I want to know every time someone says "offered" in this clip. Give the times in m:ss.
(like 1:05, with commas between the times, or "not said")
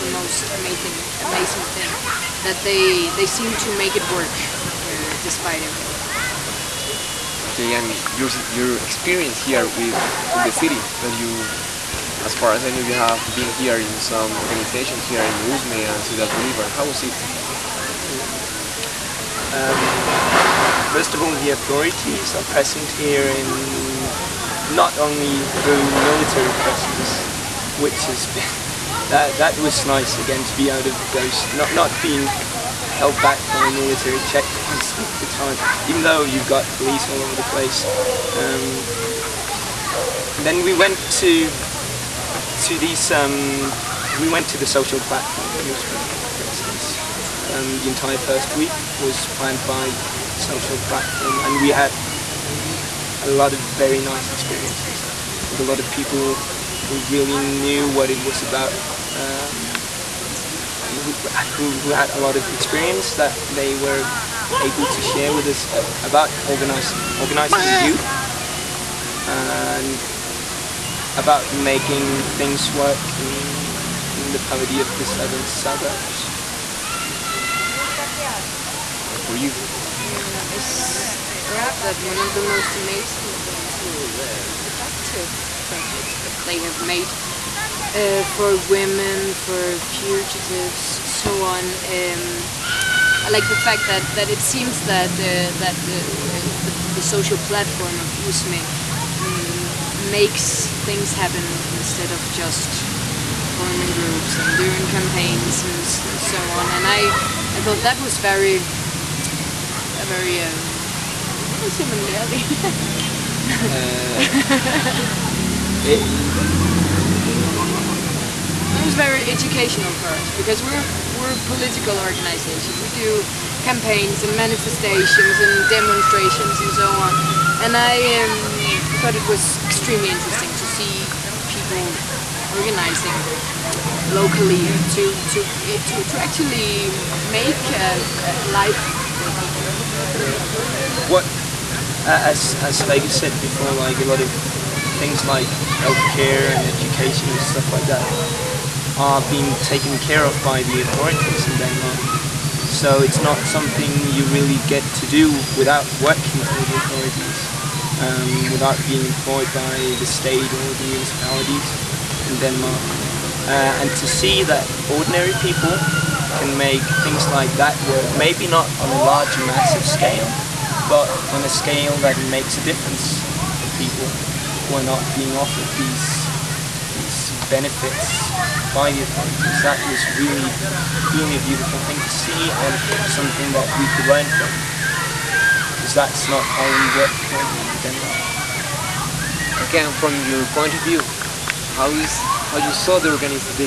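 2:55.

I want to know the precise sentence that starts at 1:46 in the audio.
And I, I thought that was very, a very uh, um, similarly.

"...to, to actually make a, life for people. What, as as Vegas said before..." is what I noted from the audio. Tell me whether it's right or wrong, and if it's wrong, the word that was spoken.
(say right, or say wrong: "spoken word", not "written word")
right.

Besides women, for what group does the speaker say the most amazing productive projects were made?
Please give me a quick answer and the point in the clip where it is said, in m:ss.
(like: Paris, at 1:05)
fugitives, at 1:29.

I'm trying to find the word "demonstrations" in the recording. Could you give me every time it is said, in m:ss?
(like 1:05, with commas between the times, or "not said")
2:05.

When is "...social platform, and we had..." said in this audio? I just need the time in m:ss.
0:50.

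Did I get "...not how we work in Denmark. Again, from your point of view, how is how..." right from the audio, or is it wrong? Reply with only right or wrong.
right.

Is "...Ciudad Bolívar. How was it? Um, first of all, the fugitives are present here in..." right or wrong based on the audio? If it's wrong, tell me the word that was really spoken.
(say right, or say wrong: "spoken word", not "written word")
wrong: "authorities", not "fugitives".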